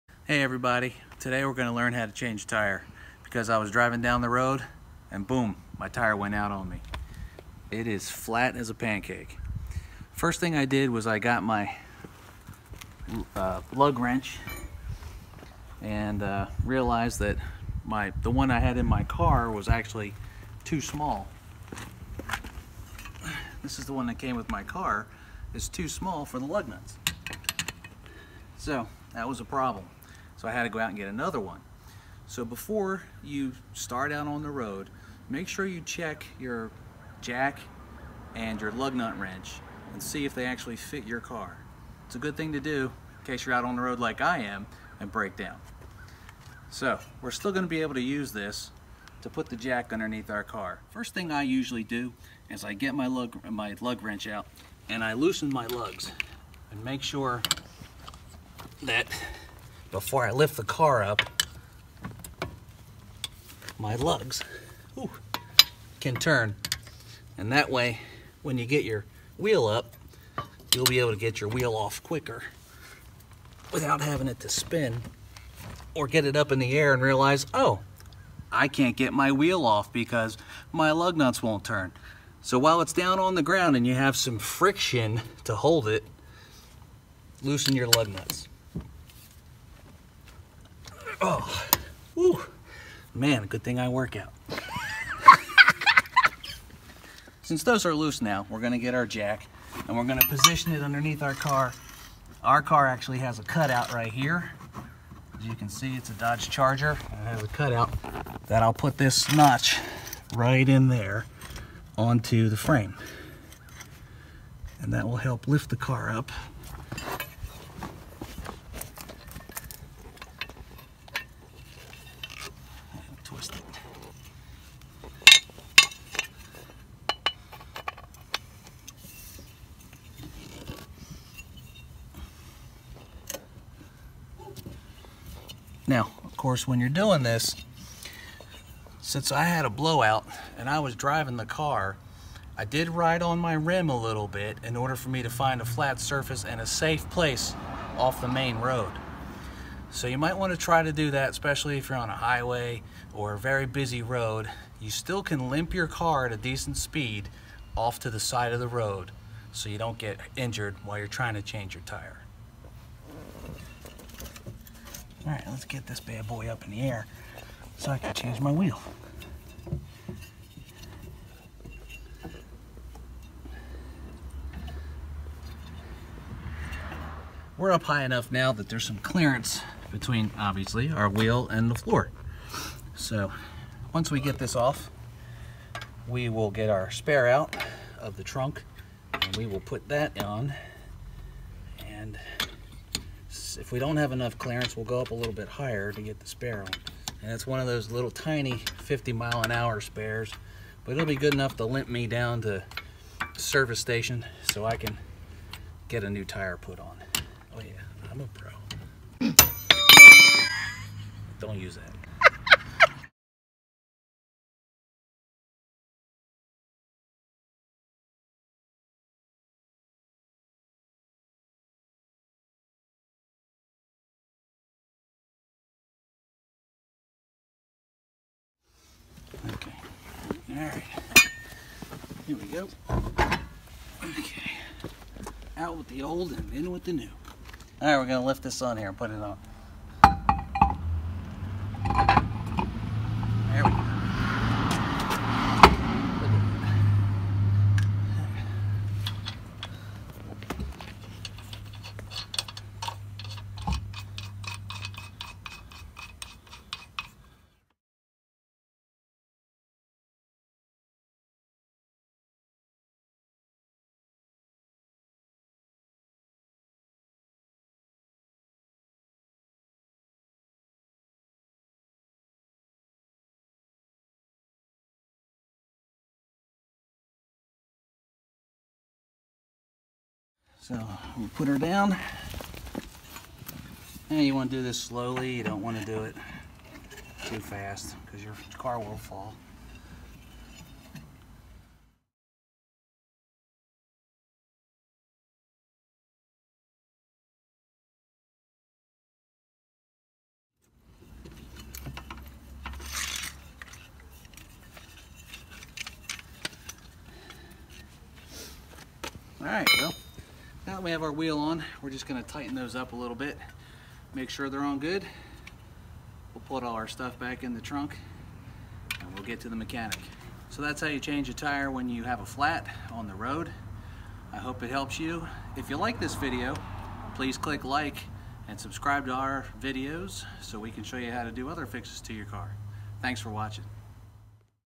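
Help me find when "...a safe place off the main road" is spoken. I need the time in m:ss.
2:26.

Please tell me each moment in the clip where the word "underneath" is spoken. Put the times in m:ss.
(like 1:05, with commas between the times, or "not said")
0:49, 1:40.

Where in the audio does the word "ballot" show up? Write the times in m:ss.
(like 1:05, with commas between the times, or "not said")
not said.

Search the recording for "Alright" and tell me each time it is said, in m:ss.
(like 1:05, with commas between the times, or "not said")
3:50, 3:57.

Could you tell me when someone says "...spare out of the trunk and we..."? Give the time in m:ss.
3:06.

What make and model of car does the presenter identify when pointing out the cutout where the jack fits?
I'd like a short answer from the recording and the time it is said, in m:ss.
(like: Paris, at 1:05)
Dodge Charger, at 1:46.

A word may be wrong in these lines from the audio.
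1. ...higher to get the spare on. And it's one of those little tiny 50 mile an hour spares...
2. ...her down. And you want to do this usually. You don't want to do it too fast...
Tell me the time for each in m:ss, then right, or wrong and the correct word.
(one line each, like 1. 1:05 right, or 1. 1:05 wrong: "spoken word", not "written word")
1. 3:15 right
2. 4:41 wrong: "slowly", not "usually".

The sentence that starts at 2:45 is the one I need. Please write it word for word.
All right, let's get this bad boy up in the air so I can change my wheel.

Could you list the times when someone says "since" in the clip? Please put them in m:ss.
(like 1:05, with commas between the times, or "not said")
1:37, 2:19.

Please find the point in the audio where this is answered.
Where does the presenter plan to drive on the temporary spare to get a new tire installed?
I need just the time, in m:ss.
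3:23.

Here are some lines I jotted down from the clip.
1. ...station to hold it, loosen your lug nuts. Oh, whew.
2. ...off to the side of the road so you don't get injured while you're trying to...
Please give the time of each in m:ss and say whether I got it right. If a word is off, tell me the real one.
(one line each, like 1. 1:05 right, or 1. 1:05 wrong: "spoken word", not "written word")
1. 1:24 wrong: "friction", not "station"
2. 2:37 right.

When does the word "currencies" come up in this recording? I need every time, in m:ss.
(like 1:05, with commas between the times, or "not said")
not said.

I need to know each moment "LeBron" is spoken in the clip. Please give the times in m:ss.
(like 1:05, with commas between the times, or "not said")
not said.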